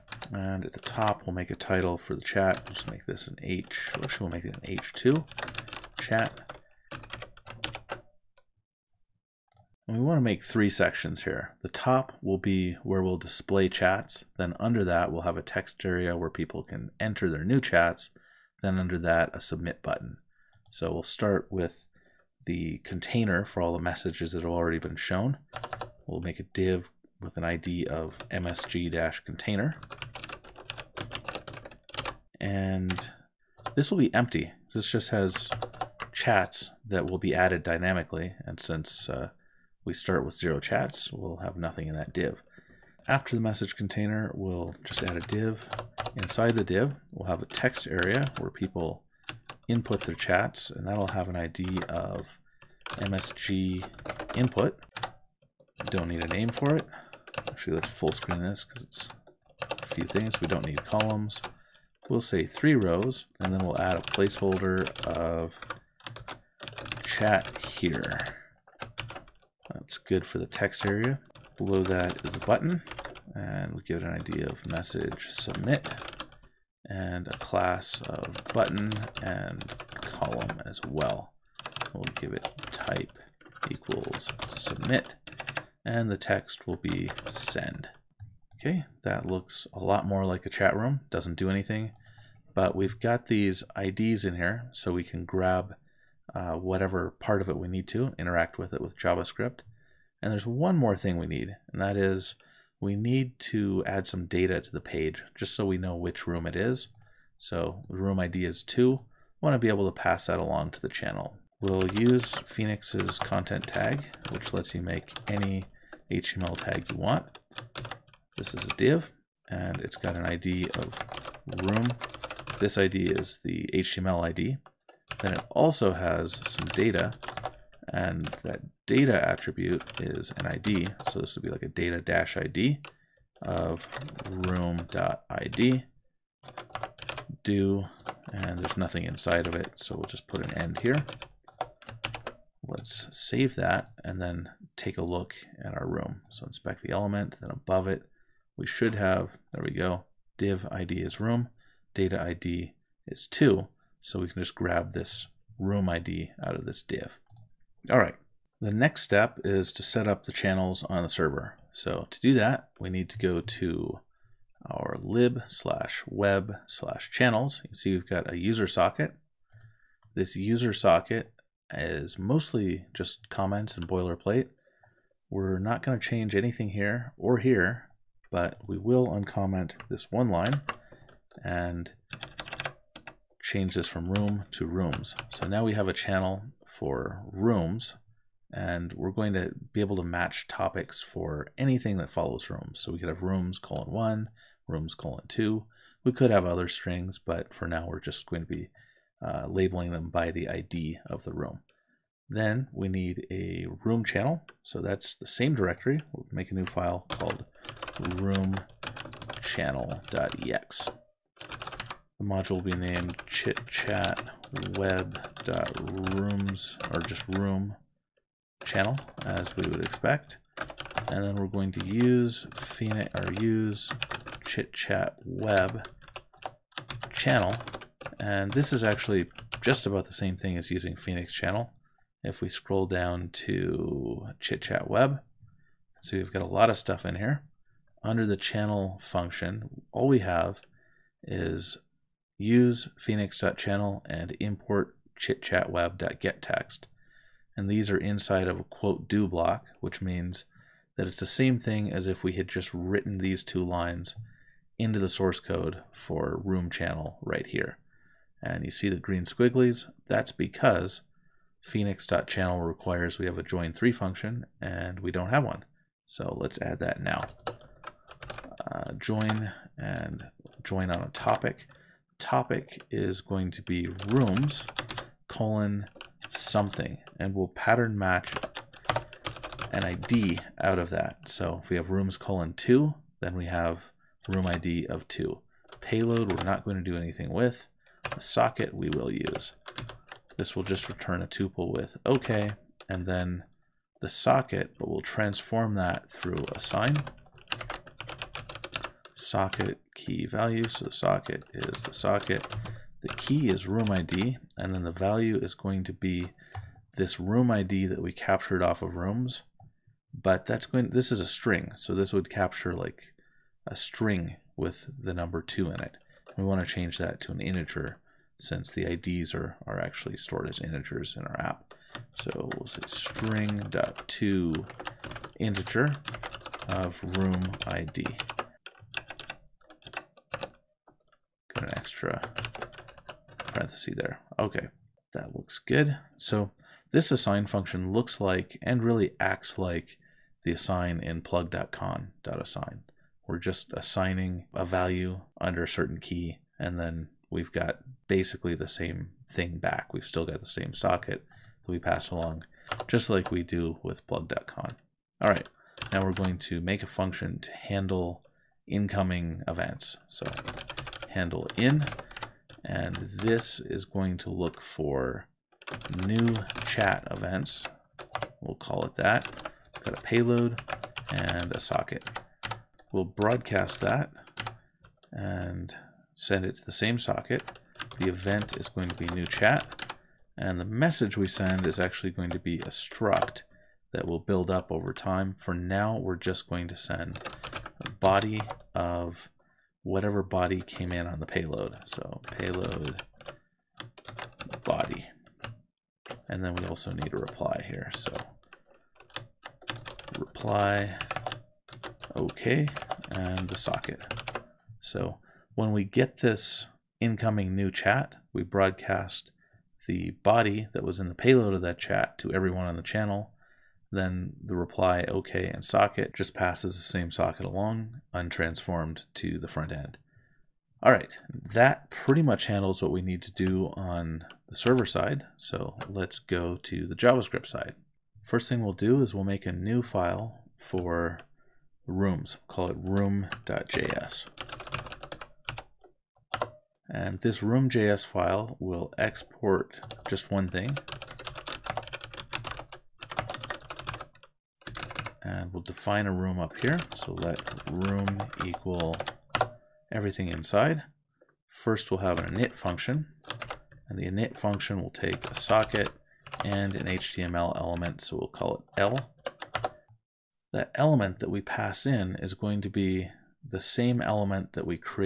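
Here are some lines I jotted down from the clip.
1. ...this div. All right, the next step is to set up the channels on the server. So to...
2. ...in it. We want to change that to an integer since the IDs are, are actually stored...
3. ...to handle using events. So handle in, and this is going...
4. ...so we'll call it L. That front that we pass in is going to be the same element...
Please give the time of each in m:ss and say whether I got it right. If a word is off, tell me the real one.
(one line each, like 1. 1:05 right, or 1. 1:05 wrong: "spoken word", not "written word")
1. 2:36 right
2. 5:15 right
3. 5:57 wrong: "incoming", not "using"
4. 7:38 wrong: "element", not "front".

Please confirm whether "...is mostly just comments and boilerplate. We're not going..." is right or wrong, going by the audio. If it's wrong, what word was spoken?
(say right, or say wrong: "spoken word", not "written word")
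right.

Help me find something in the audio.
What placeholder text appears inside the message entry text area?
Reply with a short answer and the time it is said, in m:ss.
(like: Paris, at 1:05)
chat here, at 1:07.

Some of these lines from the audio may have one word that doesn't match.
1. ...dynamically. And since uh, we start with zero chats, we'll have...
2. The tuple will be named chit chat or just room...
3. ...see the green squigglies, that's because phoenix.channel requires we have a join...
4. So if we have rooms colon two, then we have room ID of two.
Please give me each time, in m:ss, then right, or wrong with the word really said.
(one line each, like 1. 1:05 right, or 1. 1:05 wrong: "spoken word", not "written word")
1. 0:37 right
2. 3:32 wrong: "module", not "tuple"
3. 4:18 right
4. 4:41 right.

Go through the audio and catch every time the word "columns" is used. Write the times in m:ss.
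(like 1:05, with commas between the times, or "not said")
1:00, 1:20.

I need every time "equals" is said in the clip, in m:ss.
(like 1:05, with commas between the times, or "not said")
1:23, 7:28.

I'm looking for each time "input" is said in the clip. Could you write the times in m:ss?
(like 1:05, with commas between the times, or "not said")
0:49, 0:54.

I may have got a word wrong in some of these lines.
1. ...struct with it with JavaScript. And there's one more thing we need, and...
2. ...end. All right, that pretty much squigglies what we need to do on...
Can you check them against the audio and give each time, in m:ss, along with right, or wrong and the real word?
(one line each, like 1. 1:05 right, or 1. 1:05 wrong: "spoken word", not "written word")
1. 1:38 wrong: "interact", not "struct"
2. 6:59 wrong: "handles", not "squigglies".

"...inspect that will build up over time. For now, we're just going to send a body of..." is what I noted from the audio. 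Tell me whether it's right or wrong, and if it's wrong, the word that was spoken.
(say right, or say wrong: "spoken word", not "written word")
wrong: "struct", not "inspect".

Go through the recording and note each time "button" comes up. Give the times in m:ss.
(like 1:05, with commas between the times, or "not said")
0:19, 1:12, 1:18.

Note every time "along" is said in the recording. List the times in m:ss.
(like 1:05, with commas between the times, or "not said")
1:50, 5:52, 6:57.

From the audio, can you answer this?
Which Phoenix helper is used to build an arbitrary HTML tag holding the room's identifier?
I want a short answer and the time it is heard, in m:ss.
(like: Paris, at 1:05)
content tag, at 1:53.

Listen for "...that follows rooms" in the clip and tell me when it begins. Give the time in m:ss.
3:11.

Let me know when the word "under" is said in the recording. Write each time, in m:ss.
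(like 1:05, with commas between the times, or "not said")
0:14, 0:18, 3:58, 5:45.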